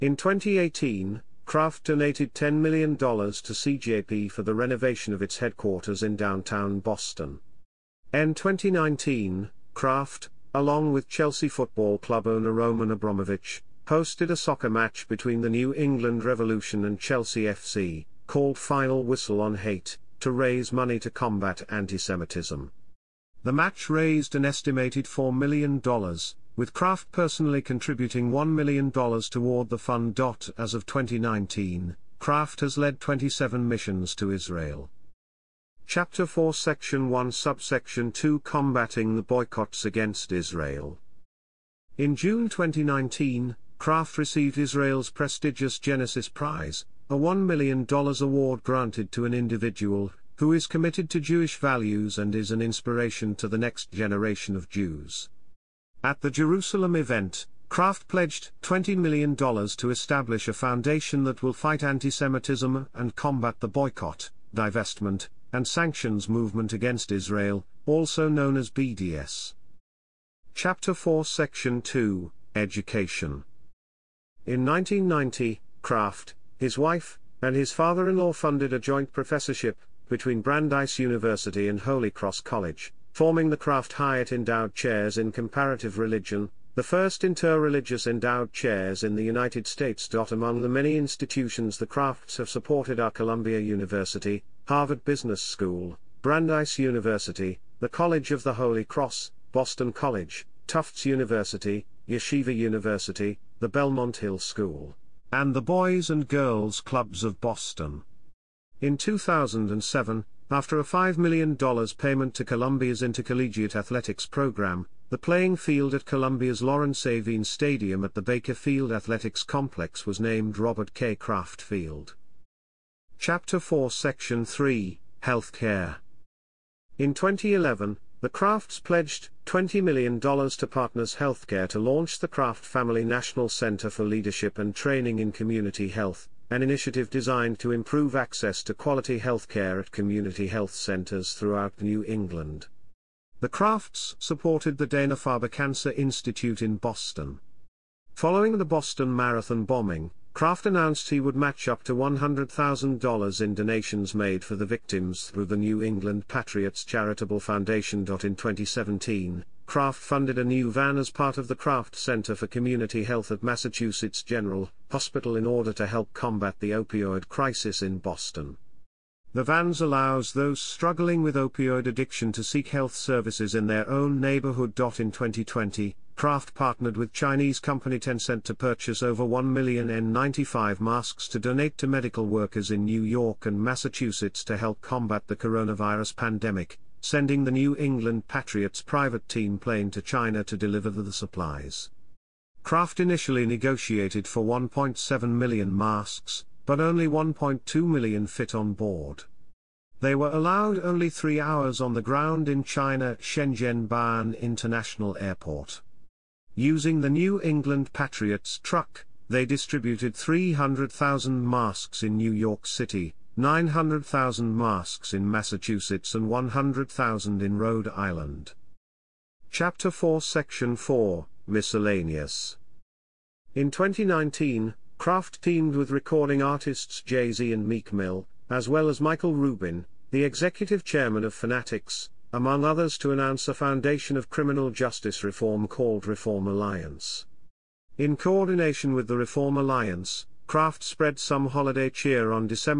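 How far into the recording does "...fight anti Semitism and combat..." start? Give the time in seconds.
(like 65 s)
61 s.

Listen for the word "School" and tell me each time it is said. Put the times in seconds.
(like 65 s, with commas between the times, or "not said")
95 s, 104 s.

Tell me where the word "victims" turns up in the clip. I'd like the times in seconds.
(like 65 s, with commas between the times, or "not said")
154 s.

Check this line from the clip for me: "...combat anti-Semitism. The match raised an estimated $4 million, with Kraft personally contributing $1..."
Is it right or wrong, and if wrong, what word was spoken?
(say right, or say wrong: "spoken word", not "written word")
right.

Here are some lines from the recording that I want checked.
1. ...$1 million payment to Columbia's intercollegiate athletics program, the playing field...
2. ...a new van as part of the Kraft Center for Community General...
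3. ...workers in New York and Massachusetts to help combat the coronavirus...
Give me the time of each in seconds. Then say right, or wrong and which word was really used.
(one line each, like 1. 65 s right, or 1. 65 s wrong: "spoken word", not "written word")
1. 110 s wrong: "5", not "1"
2. 160 s wrong: "Health", not "General"
3. 182 s right.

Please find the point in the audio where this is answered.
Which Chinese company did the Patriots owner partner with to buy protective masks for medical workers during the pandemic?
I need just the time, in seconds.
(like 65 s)
177 s.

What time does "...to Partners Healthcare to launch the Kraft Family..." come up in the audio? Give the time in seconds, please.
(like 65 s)
130 s.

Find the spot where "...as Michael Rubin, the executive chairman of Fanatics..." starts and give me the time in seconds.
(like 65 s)
228 s.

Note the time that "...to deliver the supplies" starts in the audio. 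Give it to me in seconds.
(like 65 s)
190 s.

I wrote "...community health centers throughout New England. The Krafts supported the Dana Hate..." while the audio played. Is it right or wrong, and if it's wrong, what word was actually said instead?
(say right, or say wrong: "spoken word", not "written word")
wrong: "Farber", not "Hate".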